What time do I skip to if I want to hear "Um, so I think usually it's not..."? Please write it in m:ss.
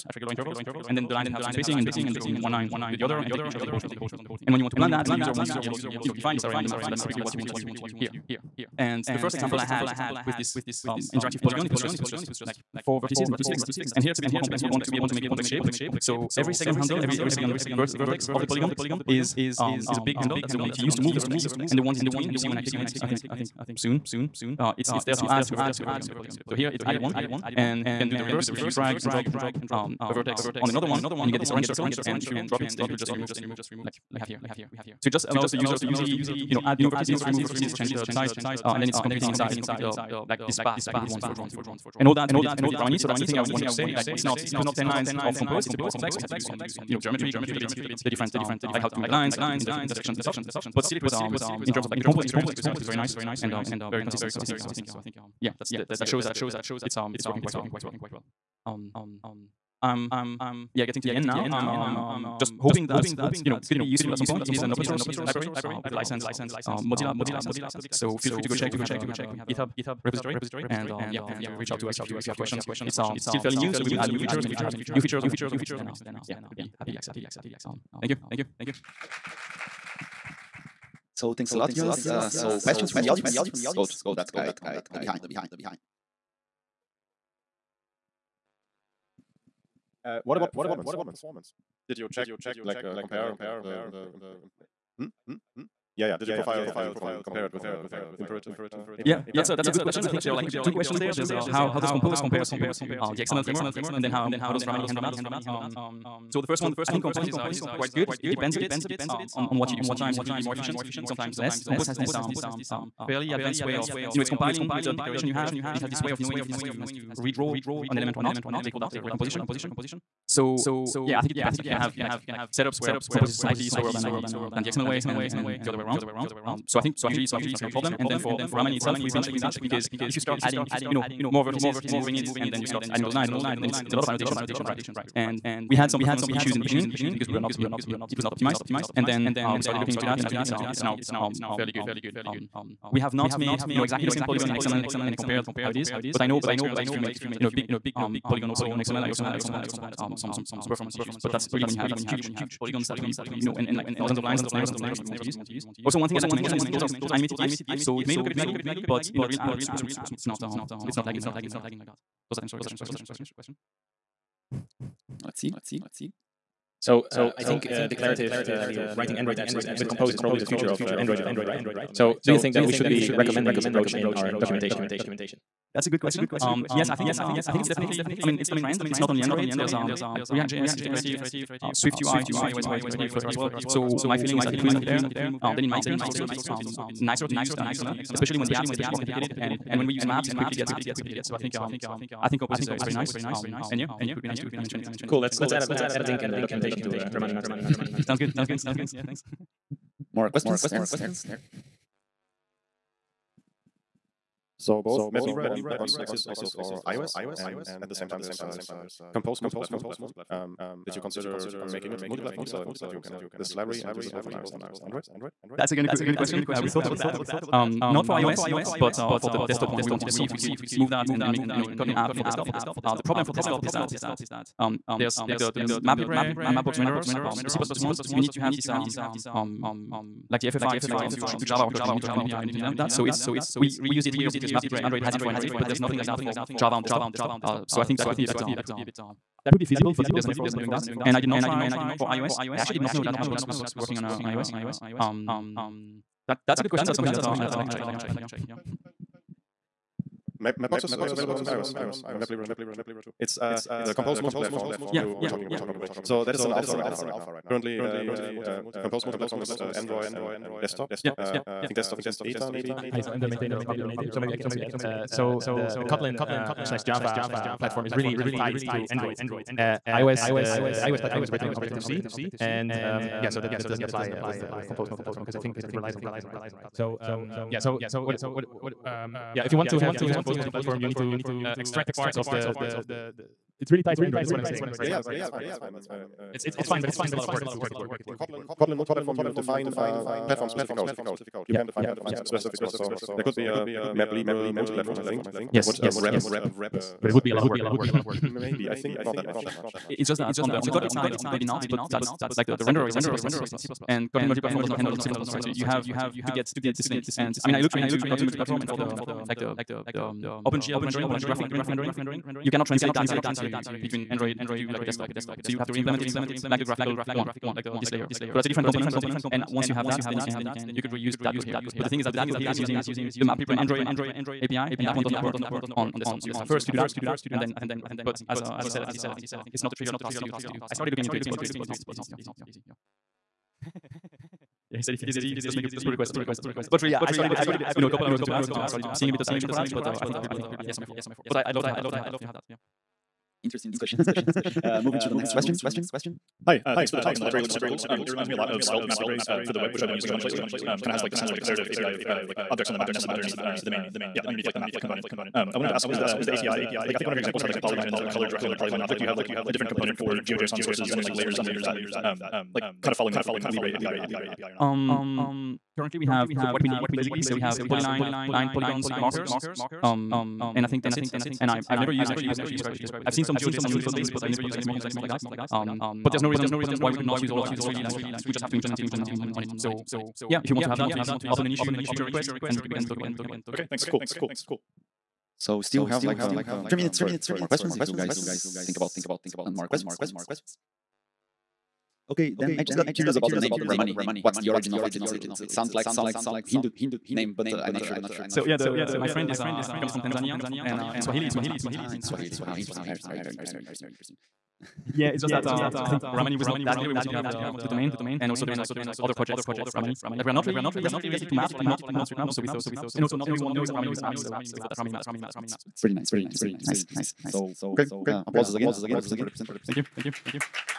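2:06.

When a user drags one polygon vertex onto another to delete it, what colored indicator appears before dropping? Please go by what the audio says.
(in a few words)
Orange circle.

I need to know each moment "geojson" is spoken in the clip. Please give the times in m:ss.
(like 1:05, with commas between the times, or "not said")
6:00, 6:13.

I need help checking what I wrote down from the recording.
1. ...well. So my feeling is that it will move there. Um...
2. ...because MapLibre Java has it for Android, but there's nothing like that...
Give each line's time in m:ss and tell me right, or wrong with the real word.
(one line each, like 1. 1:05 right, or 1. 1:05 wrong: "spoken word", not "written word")
1. 3:03 right
2. 3:54 wrong: "Android", not "Java".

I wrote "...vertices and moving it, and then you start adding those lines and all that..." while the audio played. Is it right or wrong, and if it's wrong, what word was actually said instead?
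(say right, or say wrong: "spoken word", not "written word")
right.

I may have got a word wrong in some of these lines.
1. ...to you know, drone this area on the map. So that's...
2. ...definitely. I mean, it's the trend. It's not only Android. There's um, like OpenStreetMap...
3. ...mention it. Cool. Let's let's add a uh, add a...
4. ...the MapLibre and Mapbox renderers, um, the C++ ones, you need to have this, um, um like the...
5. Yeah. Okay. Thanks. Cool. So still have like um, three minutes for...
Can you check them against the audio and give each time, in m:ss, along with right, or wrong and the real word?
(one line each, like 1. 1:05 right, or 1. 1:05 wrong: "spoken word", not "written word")
1. 0:05 wrong: "define", not "drone"
2. 2:57 wrong: "React", not "OpenStreetMap"
3. 3:14 right
4. 3:45 right
5. 6:23 right.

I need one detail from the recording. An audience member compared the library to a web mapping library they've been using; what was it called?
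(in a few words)
Svelte MapLibre.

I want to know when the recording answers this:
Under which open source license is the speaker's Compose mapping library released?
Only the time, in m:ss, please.
1:06.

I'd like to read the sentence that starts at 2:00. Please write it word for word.
So yeah, I think it depends.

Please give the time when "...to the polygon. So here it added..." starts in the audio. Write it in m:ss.
0:25.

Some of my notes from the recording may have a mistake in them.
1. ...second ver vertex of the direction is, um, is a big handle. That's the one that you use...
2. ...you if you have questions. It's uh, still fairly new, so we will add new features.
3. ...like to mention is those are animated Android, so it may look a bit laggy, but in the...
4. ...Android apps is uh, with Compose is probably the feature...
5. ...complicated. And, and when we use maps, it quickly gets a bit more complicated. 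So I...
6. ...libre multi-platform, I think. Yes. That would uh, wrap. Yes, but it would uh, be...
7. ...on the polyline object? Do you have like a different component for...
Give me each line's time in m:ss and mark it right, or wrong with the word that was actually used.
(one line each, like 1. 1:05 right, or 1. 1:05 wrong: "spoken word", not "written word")
1. 0:17 wrong: "polygon", not "direction"
2. 1:12 right
3. 2:36 wrong: "GIFs", not "Android"
4. 2:49 wrong: "future", not "feature"
5. 3:08 right
6. 4:54 right
7. 5:58 right.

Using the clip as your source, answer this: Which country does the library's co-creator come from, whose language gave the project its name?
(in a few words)
Tanzania.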